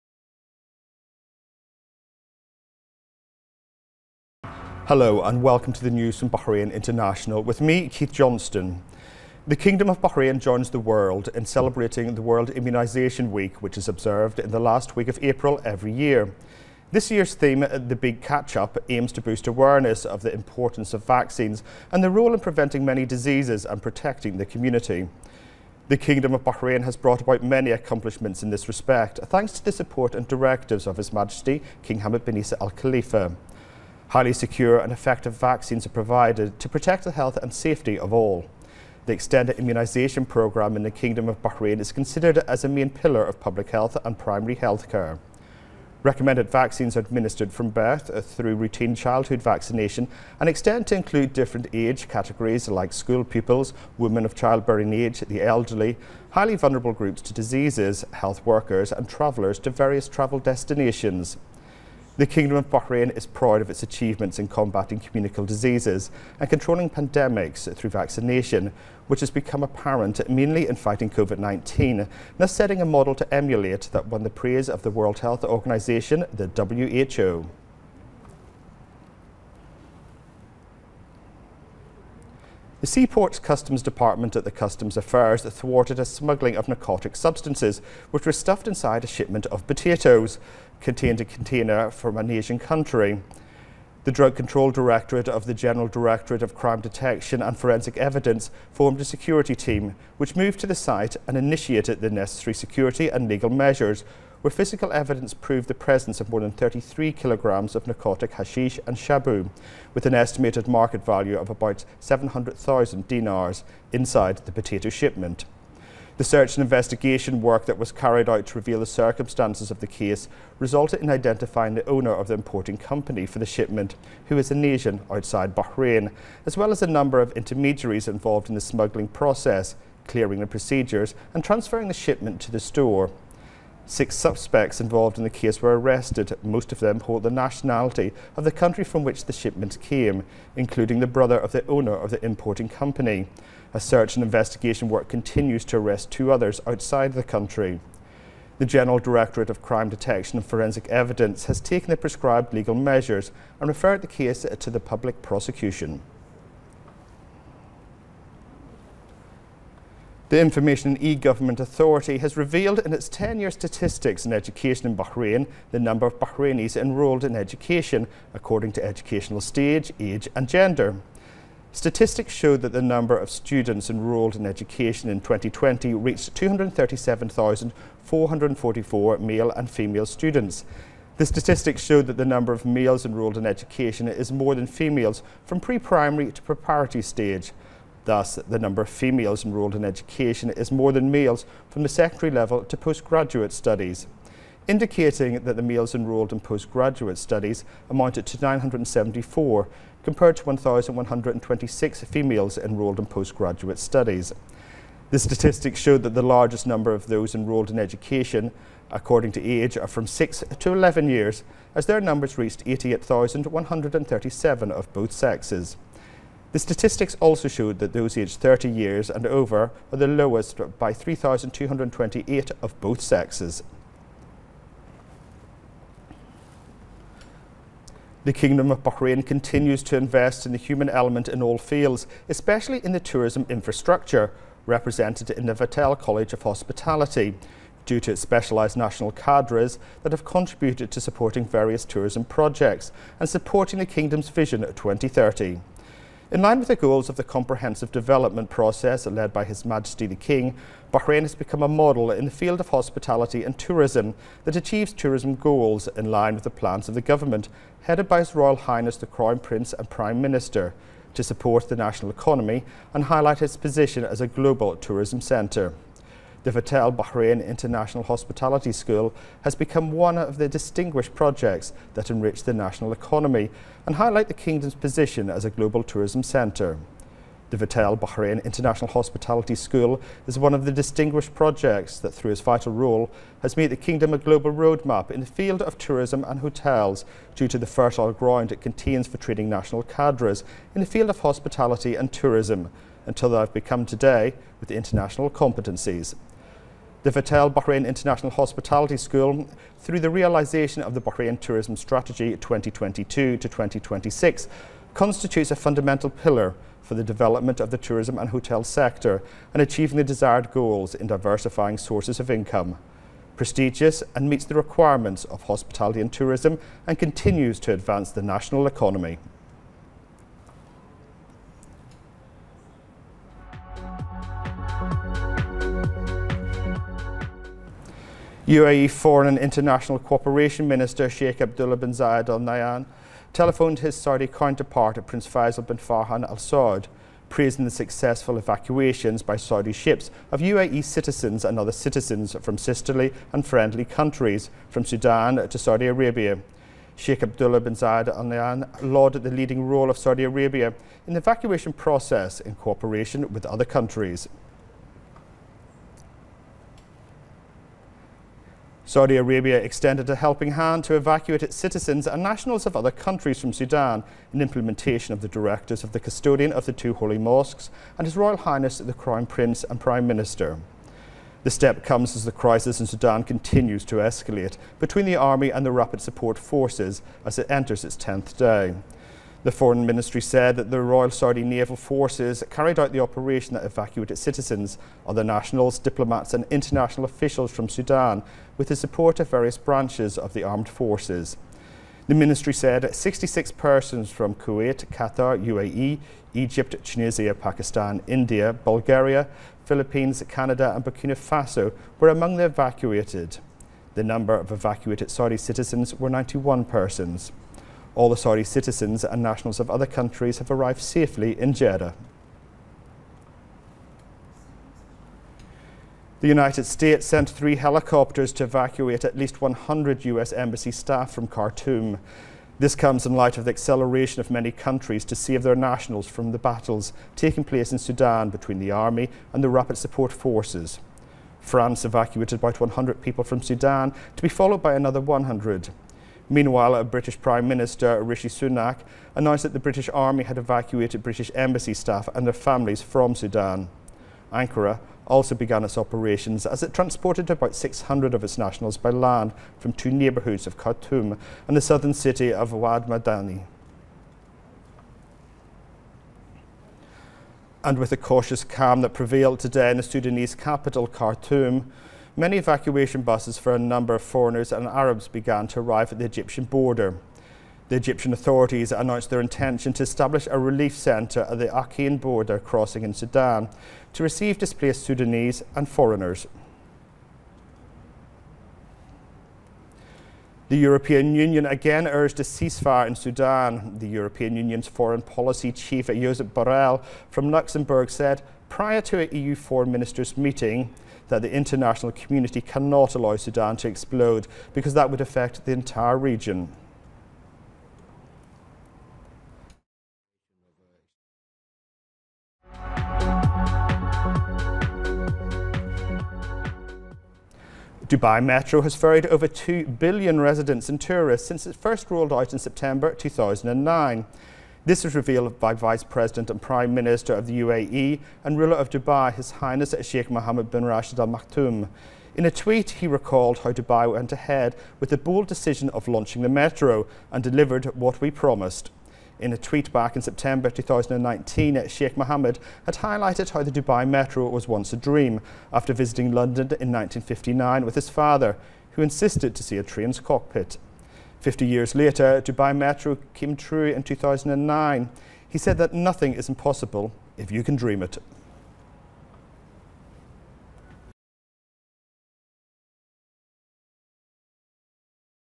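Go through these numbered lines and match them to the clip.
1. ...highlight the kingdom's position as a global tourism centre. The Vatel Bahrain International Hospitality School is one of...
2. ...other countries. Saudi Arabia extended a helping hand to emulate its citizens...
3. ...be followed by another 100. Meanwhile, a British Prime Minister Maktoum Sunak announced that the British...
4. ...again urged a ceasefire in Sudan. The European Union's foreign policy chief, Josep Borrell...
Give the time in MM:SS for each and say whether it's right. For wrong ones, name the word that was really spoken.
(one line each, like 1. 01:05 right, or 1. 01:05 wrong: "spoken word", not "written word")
1. 04:33 right
2. 05:53 wrong: "evacuate", not "emulate"
3. 07:14 wrong: "Rishi", not "Maktoum"
4. 08:01 right.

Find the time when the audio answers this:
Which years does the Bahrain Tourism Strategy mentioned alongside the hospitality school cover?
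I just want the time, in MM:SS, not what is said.
05:02.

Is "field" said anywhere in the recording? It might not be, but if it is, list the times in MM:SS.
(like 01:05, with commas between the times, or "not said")
03:51, 04:12, 04:45, 04:50.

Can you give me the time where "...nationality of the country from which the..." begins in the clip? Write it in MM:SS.
02:17.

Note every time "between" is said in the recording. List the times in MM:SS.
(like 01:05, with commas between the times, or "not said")
06:14, 07:08.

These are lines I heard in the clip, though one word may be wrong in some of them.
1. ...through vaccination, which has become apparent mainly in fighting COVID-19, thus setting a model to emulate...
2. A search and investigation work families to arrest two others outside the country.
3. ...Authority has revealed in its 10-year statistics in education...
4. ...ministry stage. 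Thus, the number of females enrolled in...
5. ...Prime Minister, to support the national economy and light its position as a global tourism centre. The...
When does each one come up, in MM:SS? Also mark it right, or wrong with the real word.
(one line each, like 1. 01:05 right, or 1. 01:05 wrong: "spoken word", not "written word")
1. 01:07 right
2. 02:23 wrong: "continues", not "families"
3. 02:41 right
4. 03:06 wrong: "preparatory", not "ministry"
5. 04:19 wrong: "highlight", not "light".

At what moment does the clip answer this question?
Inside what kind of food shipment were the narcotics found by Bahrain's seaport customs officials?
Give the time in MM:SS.
01:29.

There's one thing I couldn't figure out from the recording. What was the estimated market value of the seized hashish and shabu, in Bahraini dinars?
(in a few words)
700,000 dinars.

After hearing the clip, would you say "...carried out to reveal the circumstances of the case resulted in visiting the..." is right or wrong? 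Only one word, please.
wrong.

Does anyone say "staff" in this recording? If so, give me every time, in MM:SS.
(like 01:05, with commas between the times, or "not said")
07:00, 07:21.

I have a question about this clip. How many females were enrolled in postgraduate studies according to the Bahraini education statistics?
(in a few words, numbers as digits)
1,126.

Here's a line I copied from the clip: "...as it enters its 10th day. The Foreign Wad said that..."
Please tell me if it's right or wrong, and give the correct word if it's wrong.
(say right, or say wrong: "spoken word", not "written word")
wrong: "Ministry", not "Wad".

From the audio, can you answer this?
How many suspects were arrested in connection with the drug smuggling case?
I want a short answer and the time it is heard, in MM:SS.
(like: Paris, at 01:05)
6, at 02:13.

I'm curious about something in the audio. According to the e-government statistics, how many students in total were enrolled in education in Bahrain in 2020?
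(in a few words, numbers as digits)
237,444.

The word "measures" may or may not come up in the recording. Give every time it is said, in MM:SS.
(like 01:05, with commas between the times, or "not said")
01:43, 02:32.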